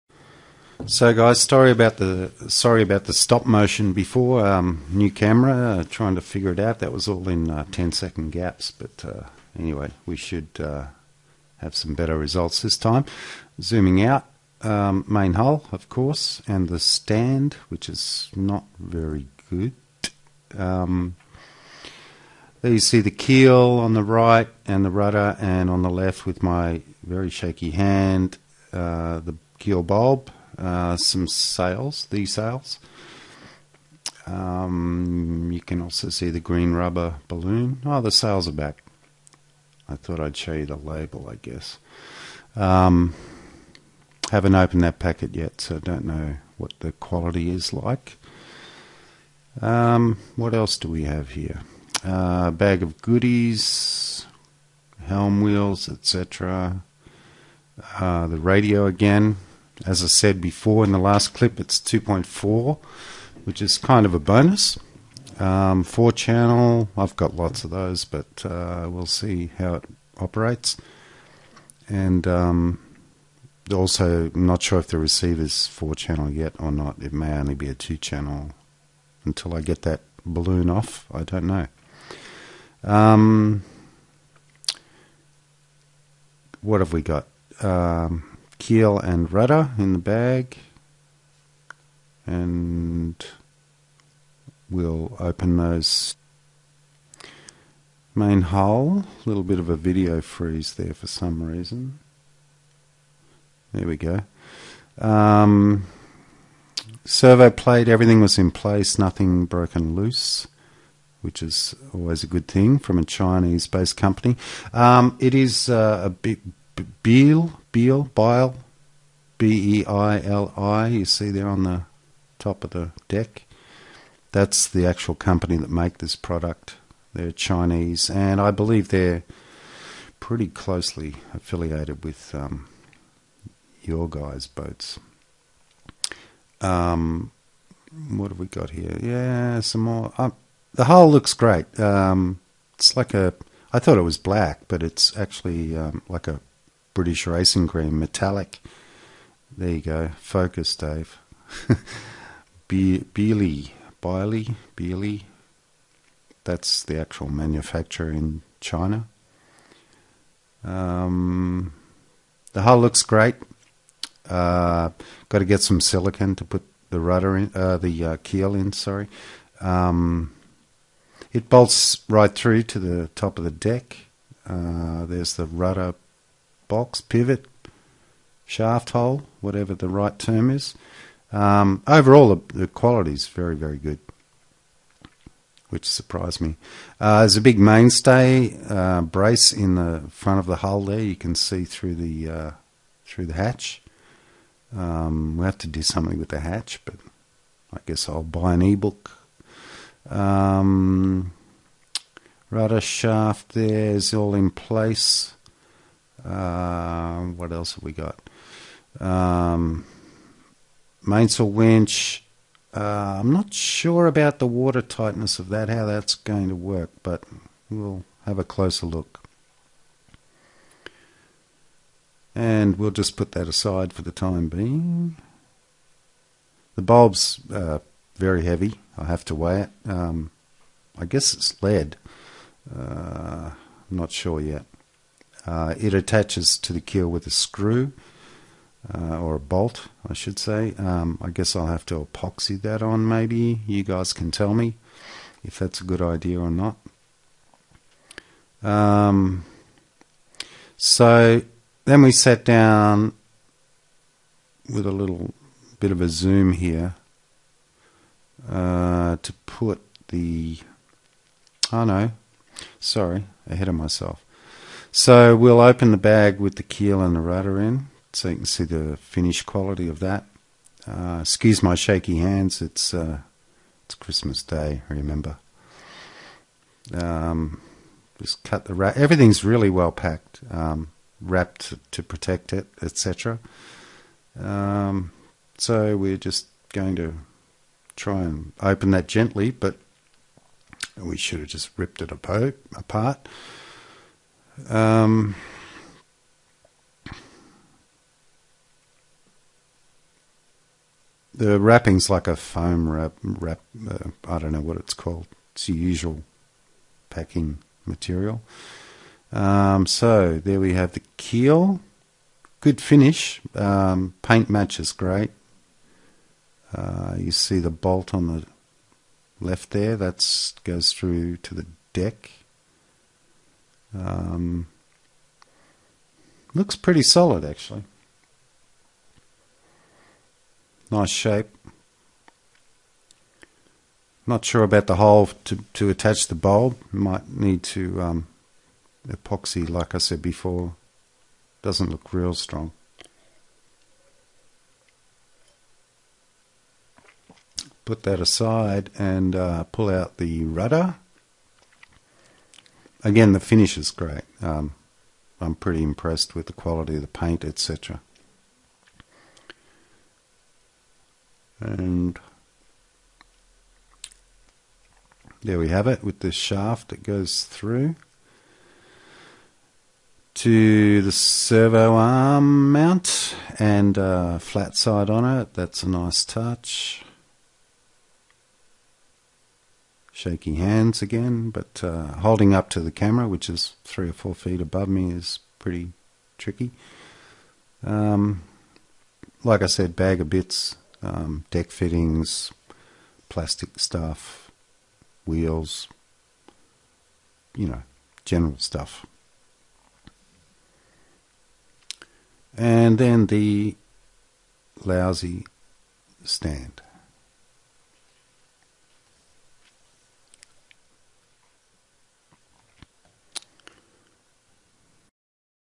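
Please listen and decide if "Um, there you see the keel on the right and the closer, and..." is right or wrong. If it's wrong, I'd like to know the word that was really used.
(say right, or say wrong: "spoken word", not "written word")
wrong: "rudder", not "closer".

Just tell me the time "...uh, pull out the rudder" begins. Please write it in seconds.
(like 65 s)
349 s.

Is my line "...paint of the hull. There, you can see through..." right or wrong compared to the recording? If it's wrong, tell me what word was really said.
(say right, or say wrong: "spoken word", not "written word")
wrong: "front", not "paint".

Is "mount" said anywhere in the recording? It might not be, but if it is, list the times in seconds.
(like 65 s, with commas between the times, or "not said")
372 s.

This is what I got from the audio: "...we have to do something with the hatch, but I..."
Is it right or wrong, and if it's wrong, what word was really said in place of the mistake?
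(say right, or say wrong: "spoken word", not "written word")
right.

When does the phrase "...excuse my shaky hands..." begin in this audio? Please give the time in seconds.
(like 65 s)
271 s.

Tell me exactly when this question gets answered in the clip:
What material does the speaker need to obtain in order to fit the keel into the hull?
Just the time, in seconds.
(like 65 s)
165 s.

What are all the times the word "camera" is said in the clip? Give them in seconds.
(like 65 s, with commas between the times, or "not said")
5 s, 382 s.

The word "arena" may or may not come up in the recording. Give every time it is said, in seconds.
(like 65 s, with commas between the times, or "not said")
not said.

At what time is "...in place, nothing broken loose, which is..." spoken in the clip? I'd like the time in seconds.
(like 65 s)
108 s.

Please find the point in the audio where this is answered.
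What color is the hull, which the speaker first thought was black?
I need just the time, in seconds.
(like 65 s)
146 s.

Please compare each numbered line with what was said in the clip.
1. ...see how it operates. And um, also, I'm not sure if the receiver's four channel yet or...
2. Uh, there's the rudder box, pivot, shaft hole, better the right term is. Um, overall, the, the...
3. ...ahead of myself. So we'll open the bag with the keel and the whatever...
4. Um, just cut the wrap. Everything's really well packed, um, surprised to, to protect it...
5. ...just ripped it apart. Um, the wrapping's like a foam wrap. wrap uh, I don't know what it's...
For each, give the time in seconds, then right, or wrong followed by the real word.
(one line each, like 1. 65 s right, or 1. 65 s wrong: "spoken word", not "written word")
1. 69 s right
2. 174 s wrong: "whatever", not "better"
3. 263 s wrong: "rudder", not "whatever"
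4. 276 s wrong: "wrapped", not "surprised"
5. 291 s right.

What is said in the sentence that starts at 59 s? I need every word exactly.
As I said before in the last clip, it's 2.4, which is kind of a bonus.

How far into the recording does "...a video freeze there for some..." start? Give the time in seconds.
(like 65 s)
99 s.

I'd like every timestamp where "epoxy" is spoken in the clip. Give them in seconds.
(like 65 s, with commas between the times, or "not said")
242 s, 339 s.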